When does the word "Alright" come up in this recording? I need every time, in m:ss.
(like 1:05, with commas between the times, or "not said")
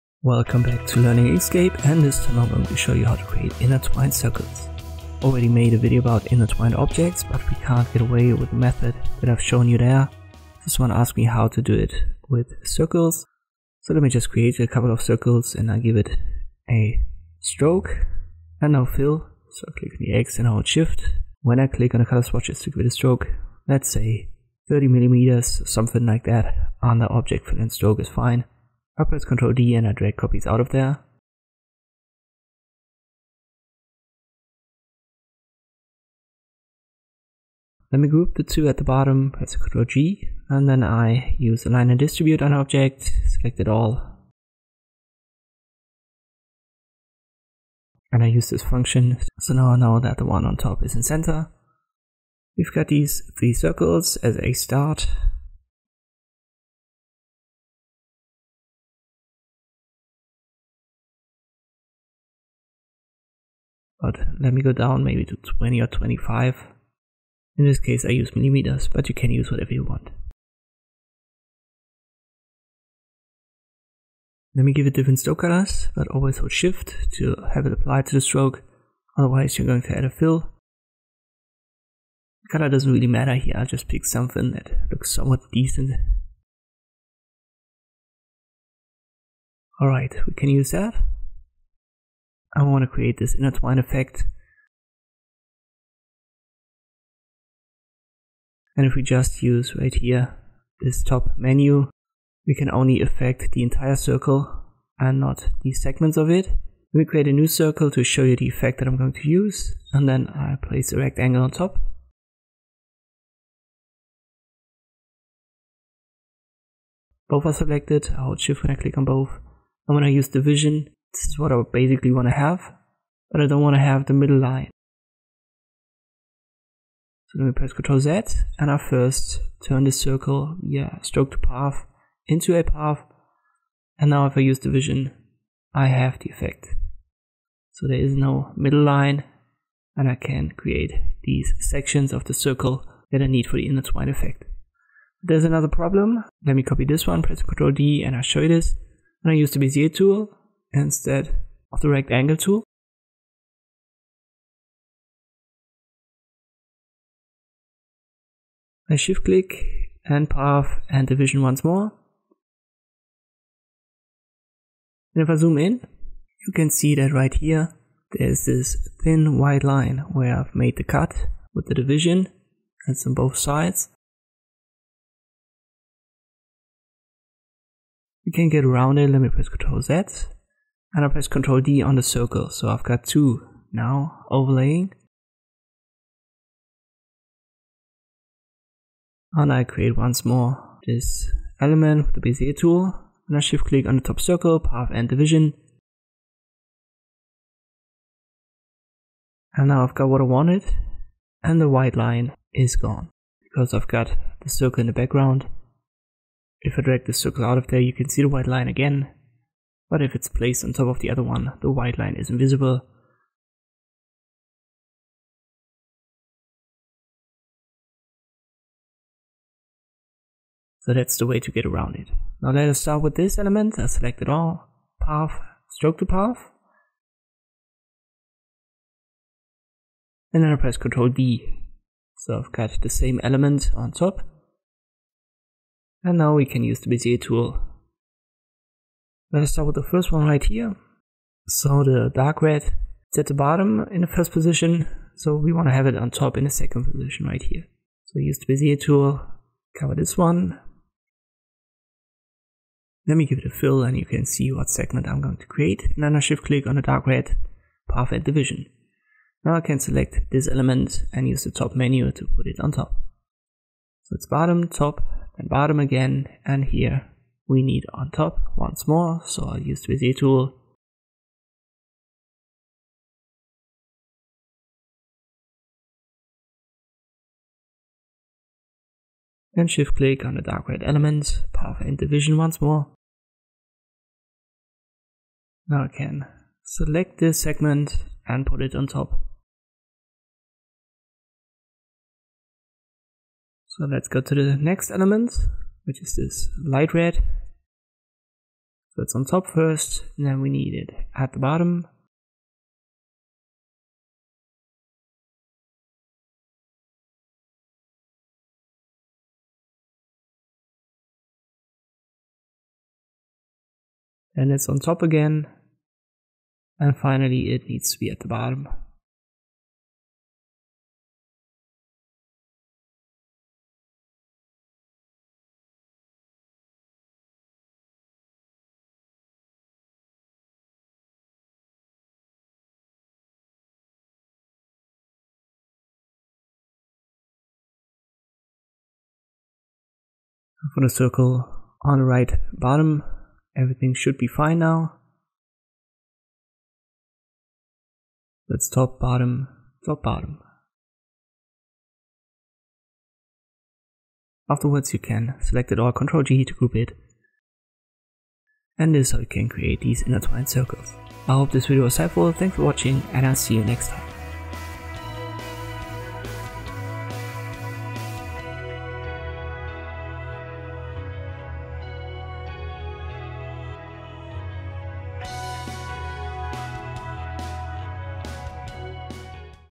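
1:29.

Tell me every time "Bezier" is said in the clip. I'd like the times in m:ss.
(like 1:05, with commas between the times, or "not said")
2:29, 3:12, 3:56, 4:08, 4:29.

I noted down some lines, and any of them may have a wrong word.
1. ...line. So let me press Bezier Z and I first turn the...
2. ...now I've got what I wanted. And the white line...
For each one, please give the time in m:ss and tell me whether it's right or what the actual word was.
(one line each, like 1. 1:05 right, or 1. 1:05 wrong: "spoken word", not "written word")
1. 2:04 wrong: "Ctrl", not "Bezier"
2. 3:19 right.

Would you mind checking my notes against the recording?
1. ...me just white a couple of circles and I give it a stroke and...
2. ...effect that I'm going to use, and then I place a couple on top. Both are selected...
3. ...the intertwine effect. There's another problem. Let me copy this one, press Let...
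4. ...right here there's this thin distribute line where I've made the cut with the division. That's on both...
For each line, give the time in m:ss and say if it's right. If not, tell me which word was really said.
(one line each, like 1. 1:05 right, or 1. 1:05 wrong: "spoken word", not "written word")
1. 0:14 wrong: "create", not "white"
2. 1:48 wrong: "rectangle", not "couple"
3. 2:23 wrong: "Ctrl", not "Let"
4. 2:47 wrong: "white", not "distribute".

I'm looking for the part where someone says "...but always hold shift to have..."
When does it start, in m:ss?
1:15.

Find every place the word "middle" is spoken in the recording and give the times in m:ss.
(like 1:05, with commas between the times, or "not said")
2:04, 2:18.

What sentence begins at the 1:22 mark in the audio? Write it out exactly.
Color doesn't really matter here, I'll just pick something that looks somewhat decent.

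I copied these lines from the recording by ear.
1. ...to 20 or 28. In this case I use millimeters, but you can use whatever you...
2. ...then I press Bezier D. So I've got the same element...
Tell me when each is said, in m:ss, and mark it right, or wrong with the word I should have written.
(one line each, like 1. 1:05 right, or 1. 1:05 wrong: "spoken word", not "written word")
1. 1:05 wrong: "25", not "28"
2. 3:50 wrong: "Ctrl", not "Bezier".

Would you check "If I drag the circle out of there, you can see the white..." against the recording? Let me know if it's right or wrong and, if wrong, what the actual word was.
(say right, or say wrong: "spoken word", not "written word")
right.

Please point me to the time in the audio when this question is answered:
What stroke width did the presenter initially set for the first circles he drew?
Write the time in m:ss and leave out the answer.
0:24.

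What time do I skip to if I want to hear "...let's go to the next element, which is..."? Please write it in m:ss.
4:53.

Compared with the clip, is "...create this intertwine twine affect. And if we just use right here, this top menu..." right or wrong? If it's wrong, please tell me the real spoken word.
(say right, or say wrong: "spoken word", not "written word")
wrong: "effect", not "affect".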